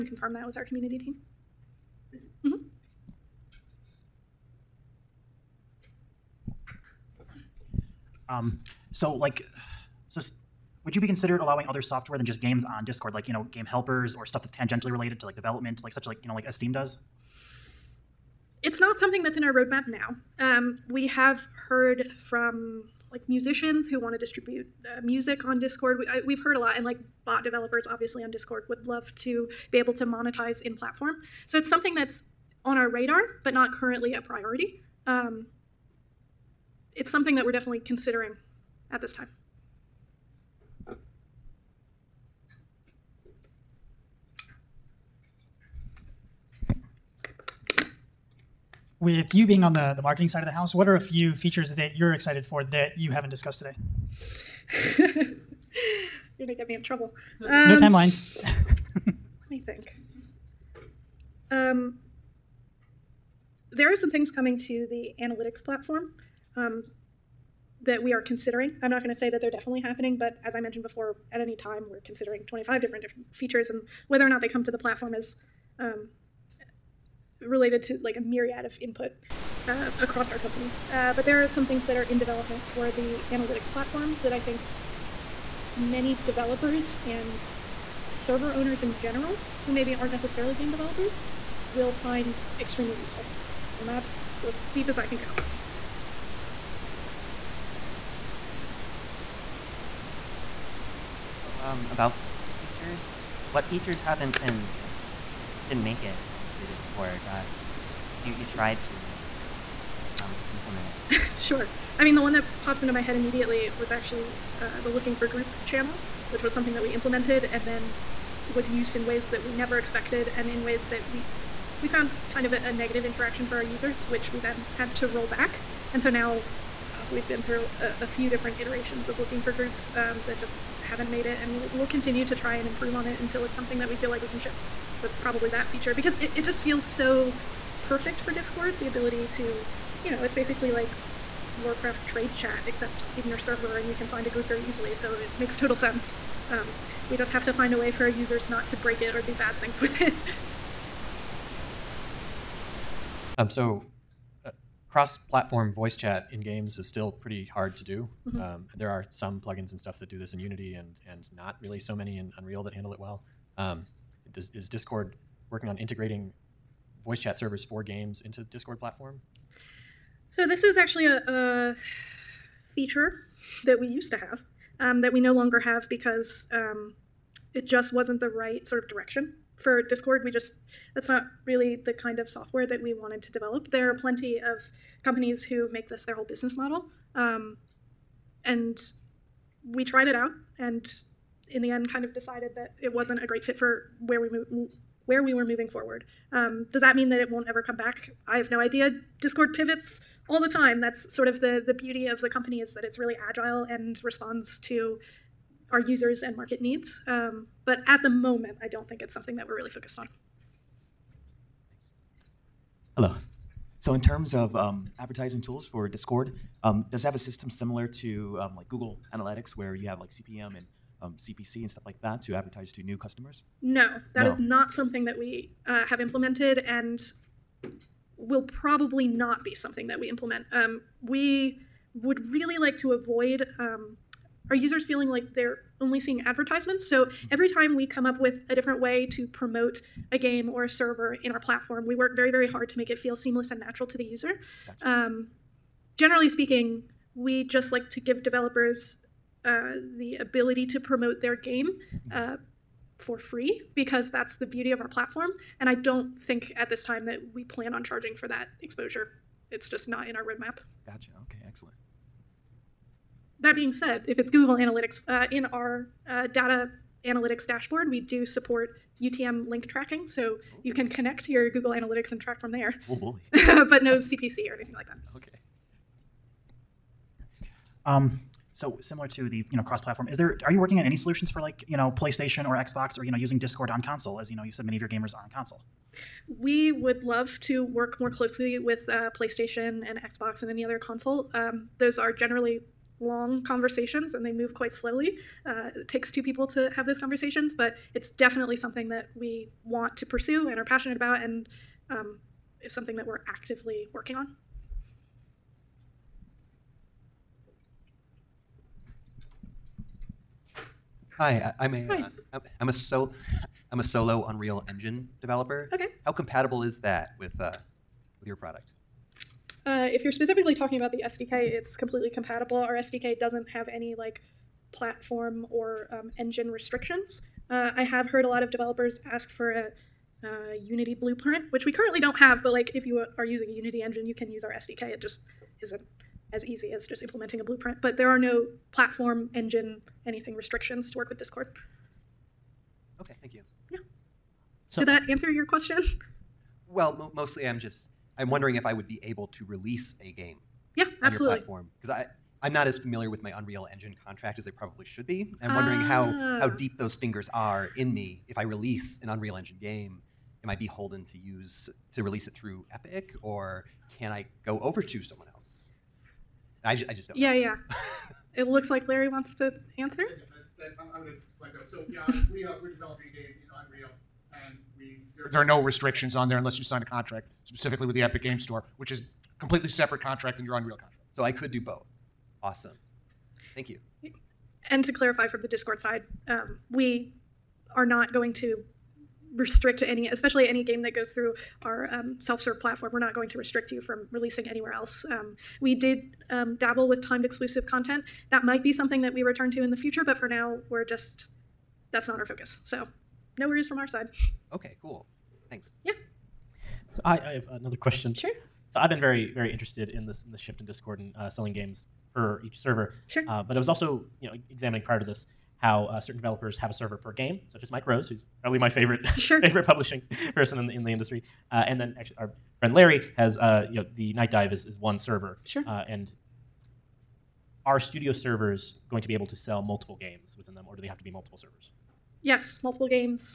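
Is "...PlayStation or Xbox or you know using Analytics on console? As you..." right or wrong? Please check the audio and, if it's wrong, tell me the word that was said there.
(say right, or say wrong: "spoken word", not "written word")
wrong: "Discord", not "Analytics".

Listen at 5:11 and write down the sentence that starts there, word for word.
Hi, I, am a, am uh, a so, I'm a solo Unreal Engine developer.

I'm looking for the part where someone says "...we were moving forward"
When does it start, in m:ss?
3:15.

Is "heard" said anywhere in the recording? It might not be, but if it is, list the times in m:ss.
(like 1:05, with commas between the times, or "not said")
0:21, 0:26, 5:28.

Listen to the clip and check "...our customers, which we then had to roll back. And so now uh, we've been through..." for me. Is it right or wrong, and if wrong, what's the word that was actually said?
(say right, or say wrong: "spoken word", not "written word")
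wrong: "users", not "customers".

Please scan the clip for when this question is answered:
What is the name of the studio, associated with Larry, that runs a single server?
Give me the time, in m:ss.
7:04.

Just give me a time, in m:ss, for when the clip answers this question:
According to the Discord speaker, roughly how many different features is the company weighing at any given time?
1:12.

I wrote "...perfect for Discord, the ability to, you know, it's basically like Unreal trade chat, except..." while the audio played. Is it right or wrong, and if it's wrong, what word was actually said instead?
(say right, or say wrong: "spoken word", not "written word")
wrong: "Warcraft", not "Unreal".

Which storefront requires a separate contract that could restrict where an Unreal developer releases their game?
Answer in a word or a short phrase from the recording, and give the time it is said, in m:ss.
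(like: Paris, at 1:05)
Epic Game Store, at 6:18.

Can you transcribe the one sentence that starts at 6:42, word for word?
So no worries from our side.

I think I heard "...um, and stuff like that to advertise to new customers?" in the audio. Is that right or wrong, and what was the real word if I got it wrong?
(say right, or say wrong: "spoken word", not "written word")
right.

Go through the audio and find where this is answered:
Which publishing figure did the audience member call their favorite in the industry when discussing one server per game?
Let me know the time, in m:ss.
6:57.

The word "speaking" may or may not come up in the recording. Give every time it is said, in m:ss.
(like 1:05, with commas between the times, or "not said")
4:06.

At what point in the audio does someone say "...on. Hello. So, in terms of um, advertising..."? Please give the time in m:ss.
3:29.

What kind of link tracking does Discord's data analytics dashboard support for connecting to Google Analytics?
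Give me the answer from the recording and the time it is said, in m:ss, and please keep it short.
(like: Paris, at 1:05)
UTM link tracking, at 4:29.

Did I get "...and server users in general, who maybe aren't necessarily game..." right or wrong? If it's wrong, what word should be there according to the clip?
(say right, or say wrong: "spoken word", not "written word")
wrong: "owners", not "users".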